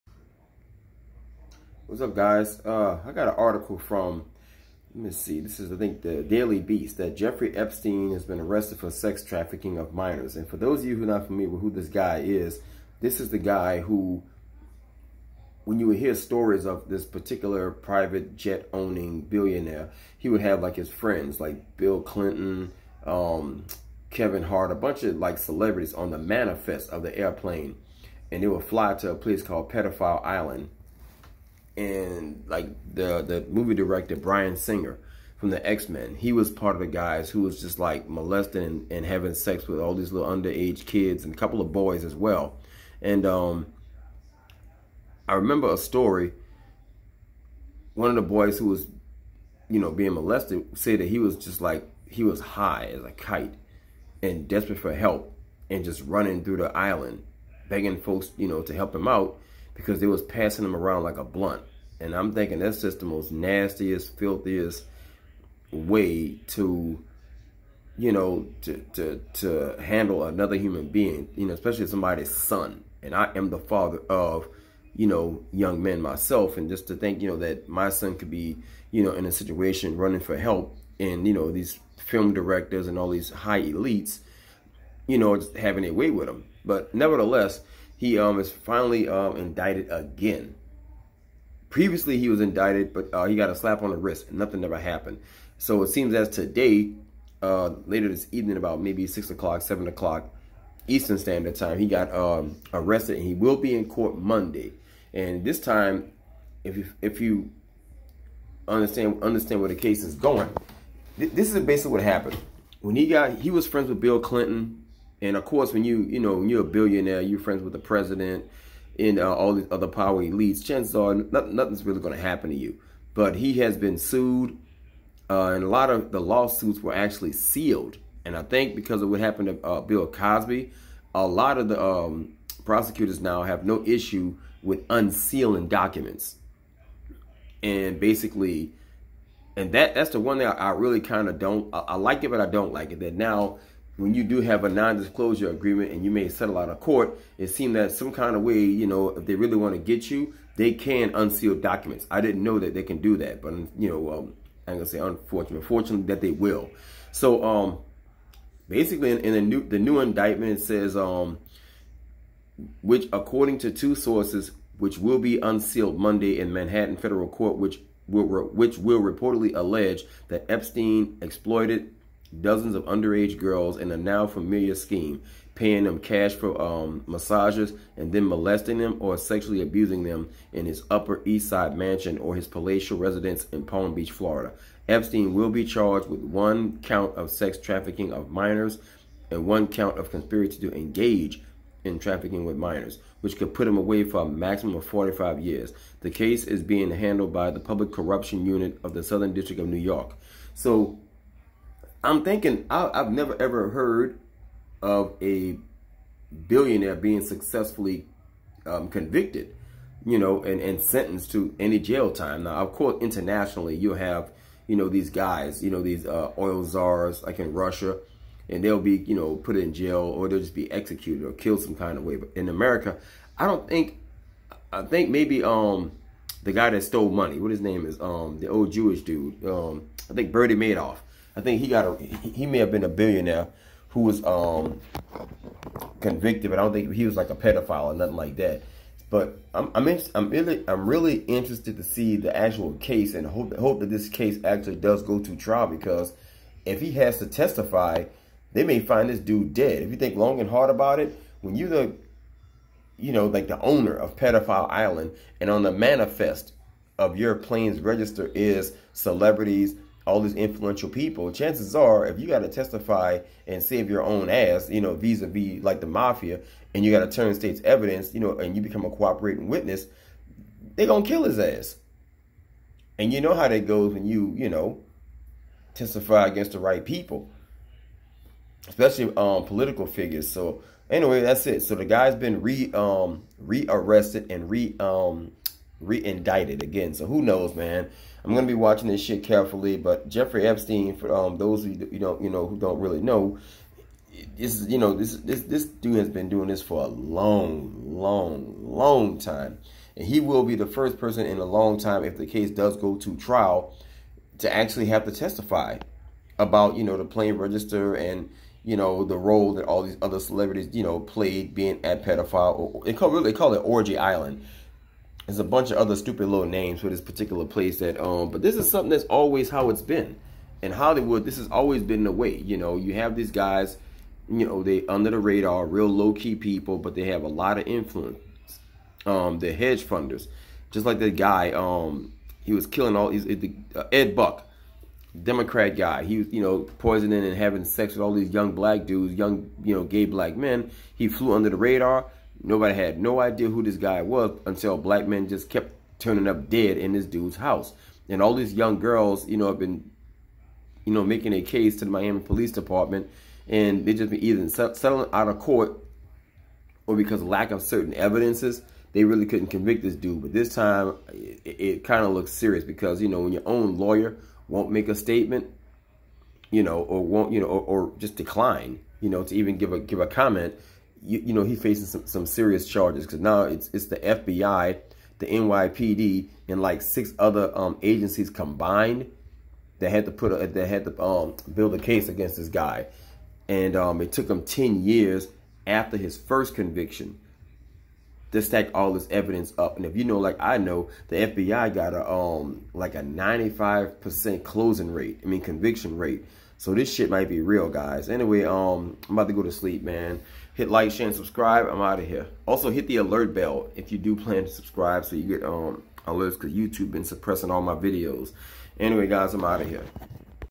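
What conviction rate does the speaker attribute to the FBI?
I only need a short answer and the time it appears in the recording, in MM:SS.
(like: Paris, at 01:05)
95%, at 06:33.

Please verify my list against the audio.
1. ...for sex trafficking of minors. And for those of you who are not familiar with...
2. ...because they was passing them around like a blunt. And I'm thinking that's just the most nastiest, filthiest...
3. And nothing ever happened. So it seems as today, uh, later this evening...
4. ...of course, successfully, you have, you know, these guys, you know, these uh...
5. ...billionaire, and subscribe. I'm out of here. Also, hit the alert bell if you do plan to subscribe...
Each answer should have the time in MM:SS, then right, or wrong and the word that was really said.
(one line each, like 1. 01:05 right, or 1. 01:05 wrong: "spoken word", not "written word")
1. 00:08 right
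2. 00:59 right
3. 01:34 right
4. 03:32 wrong: "internationally", not "successfully"
5. 06:40 wrong: "share", not "billionaire".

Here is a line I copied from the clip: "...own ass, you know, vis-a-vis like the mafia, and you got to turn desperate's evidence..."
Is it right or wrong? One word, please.
wrong.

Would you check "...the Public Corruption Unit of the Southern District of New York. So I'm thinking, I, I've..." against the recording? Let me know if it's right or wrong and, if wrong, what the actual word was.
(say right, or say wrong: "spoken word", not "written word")
right.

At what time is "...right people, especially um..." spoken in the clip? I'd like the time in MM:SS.
04:36.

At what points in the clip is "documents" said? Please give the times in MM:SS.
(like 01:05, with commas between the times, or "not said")
02:15, 02:31.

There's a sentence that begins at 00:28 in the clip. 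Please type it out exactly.
And they would fly to a place called Pedophile Island and like the the movie director Bryan Singer from the X Men.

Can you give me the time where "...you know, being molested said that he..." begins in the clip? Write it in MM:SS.
00:49.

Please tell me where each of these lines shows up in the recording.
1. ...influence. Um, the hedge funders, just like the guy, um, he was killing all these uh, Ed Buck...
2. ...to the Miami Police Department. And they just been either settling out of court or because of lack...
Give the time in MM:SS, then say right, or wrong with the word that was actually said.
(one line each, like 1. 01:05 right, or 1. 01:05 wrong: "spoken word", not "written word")
1. 05:27 right
2. 05:51 right.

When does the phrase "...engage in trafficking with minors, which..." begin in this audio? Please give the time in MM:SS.
03:10.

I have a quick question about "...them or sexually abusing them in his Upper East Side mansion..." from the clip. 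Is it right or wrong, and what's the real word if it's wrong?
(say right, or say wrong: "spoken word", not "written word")
right.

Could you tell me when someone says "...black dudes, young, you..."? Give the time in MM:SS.
05:38.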